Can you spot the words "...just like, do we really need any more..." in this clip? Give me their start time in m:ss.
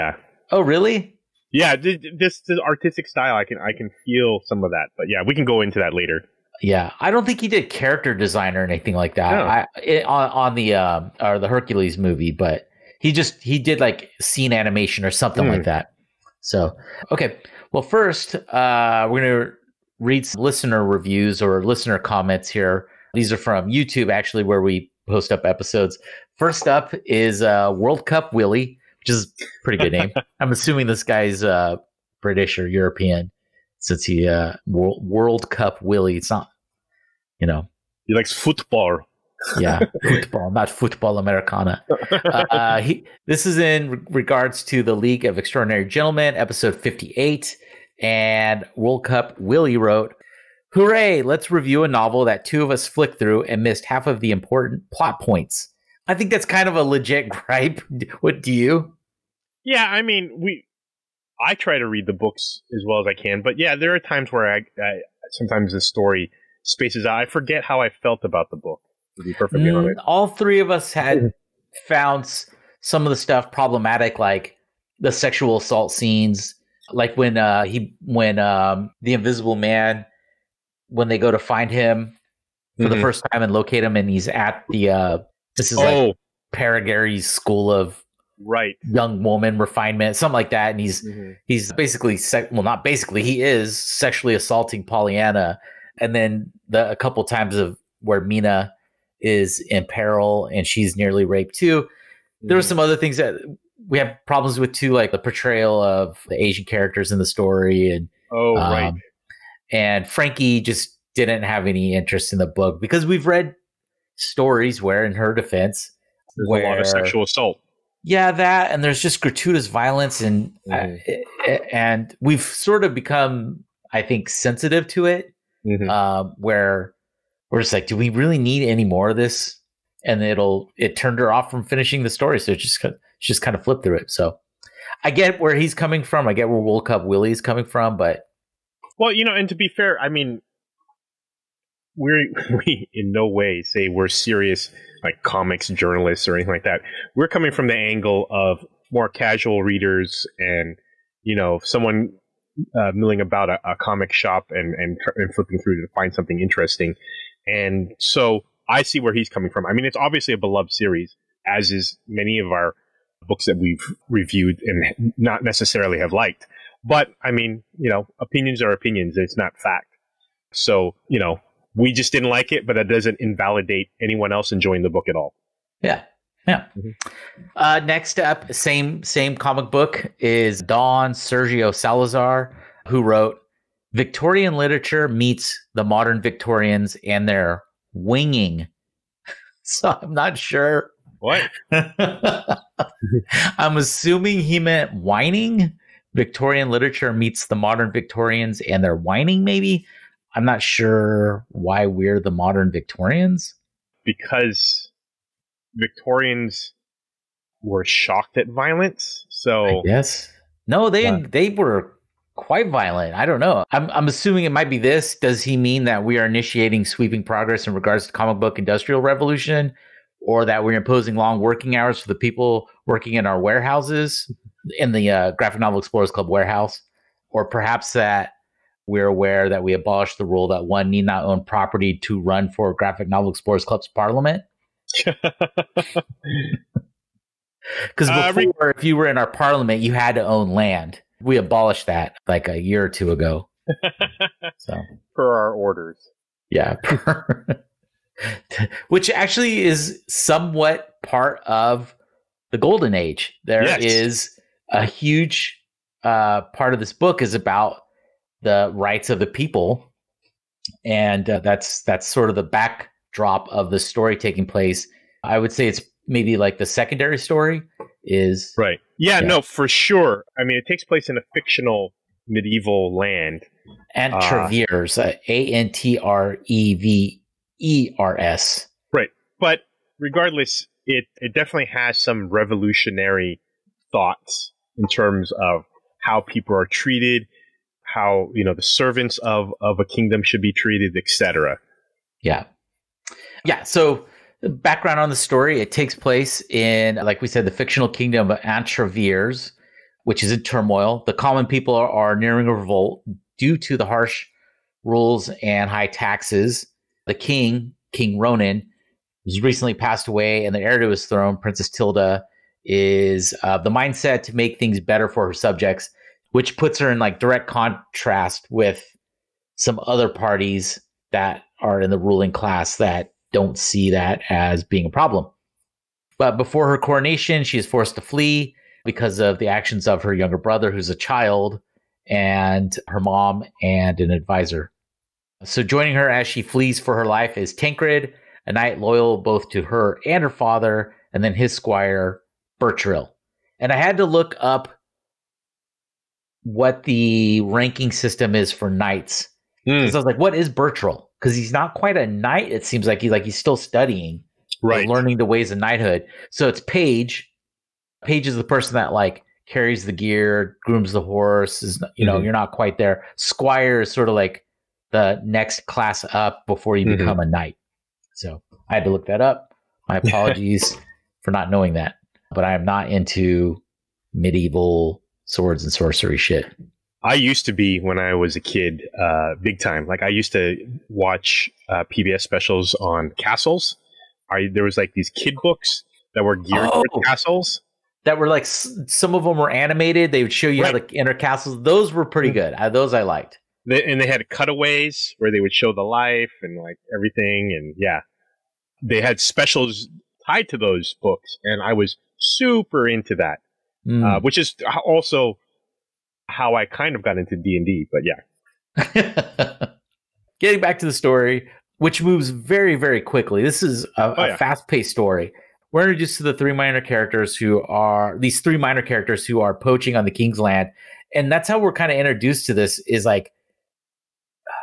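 2:07.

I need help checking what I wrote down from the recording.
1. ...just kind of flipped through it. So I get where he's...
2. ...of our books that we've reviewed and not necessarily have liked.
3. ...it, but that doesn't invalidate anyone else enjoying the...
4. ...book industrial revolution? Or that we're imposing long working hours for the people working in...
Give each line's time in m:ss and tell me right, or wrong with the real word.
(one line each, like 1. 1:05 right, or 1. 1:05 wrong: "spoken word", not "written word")
1. 2:13 right
2. 2:42 right
3. 2:52 right
4. 3:38 right.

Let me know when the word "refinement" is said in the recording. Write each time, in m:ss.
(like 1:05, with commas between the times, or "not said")
1:29.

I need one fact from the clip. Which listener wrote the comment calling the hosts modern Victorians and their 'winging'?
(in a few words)
Don Sergio Salazar.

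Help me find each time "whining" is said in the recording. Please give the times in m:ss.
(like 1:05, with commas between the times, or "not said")
3:14, 3:18.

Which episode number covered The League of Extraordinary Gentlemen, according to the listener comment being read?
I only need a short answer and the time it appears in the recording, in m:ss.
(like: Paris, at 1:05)
58, at 0:46.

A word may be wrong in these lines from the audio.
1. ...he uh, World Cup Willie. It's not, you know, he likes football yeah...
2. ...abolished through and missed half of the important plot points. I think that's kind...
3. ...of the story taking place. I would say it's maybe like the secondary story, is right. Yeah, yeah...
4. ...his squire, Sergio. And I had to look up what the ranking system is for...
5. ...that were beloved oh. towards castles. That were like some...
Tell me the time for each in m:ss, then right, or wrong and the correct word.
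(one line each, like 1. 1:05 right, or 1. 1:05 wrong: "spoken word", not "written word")
1. 0:34 right
2. 0:52 wrong: "flicked", not "abolished"
3. 4:23 right
4. 5:41 wrong: "Bertrill", not "Sergio"
5. 6:26 wrong: "geared", not "beloved".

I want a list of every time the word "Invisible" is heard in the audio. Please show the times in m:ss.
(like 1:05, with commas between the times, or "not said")
1:19.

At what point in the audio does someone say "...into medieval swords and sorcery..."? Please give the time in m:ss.
6:12.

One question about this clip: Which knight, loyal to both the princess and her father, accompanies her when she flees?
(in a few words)
Tankred.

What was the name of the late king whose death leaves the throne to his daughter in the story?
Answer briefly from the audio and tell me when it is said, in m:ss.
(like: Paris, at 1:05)
King Ronan, at 5:07.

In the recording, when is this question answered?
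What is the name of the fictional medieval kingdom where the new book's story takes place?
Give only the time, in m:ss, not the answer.
4:58.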